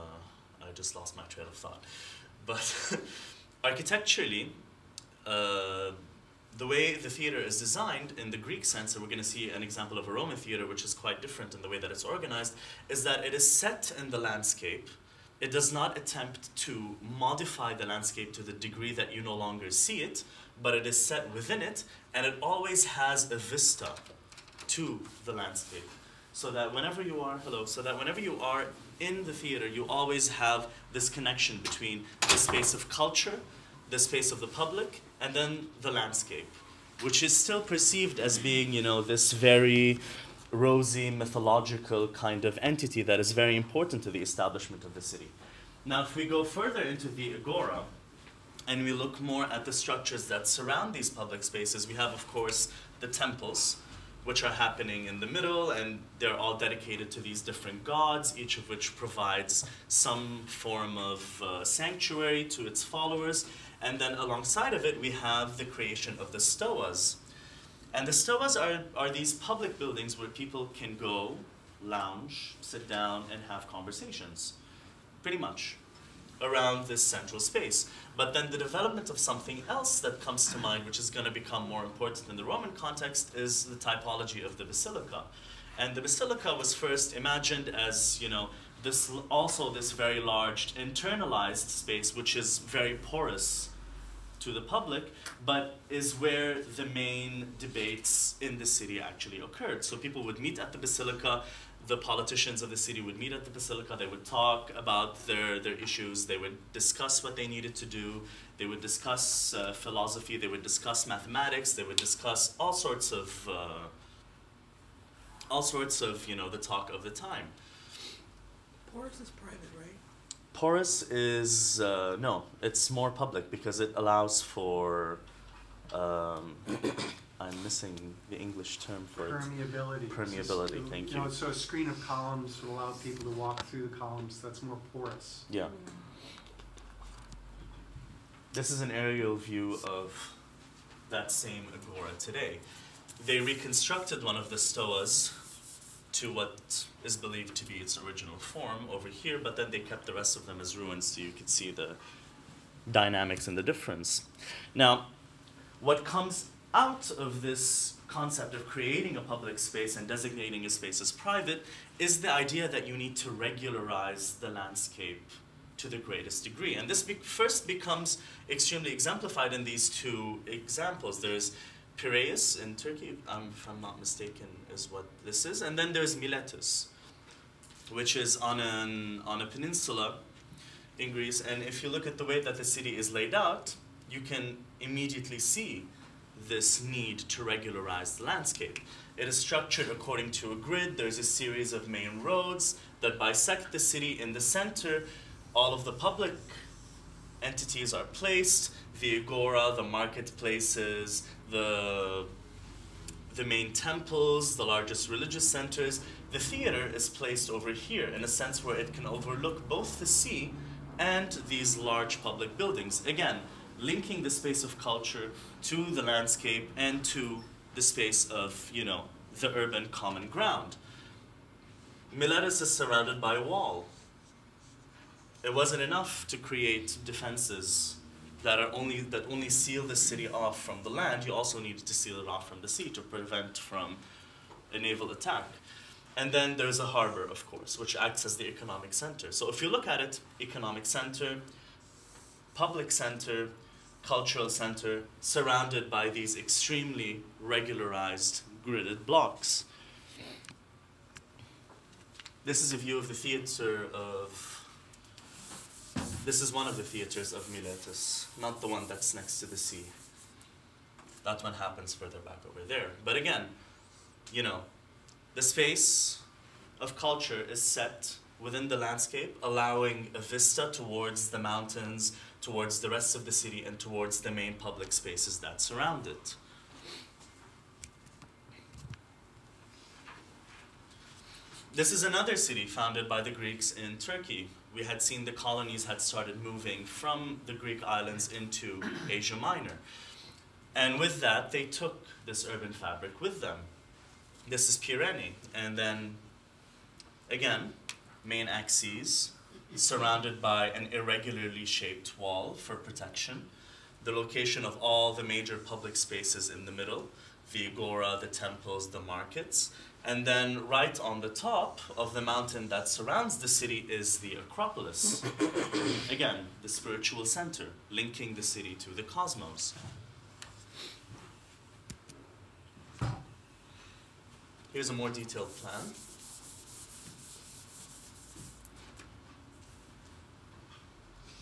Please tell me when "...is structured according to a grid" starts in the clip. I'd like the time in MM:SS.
03:09.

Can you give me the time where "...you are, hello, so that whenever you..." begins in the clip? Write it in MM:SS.
00:26.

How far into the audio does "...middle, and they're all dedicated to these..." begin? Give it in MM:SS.
00:55.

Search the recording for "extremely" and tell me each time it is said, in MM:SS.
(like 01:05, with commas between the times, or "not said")
02:48, 04:06.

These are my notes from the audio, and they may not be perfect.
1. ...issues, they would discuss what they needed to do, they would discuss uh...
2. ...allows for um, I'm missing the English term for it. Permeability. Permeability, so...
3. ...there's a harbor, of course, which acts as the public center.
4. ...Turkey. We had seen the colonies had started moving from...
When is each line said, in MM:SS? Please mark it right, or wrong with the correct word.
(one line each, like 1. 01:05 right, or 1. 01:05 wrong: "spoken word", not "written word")
1. 01:45 right
2. 02:03 right
3. 03:56 wrong: "economic", not "public"
4. 04:43 right.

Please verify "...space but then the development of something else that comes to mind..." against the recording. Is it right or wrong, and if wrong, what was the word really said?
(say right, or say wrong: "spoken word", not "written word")
right.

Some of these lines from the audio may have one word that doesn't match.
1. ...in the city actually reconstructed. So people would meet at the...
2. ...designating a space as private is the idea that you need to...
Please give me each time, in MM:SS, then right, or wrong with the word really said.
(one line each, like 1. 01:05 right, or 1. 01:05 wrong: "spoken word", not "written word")
1. 01:38 wrong: "occurred", not "reconstructed"
2. 02:40 right.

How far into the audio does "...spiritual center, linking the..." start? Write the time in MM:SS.
05:16.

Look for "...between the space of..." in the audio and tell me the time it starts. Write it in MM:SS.
00:31.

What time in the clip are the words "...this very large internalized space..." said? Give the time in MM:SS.
01:29.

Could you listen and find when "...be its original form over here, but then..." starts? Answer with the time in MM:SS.
02:27.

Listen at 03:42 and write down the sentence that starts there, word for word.
Miletus is surrounded by a wall.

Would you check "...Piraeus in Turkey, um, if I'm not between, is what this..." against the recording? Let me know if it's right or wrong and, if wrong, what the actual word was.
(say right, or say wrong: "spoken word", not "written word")
wrong: "mistaken", not "between".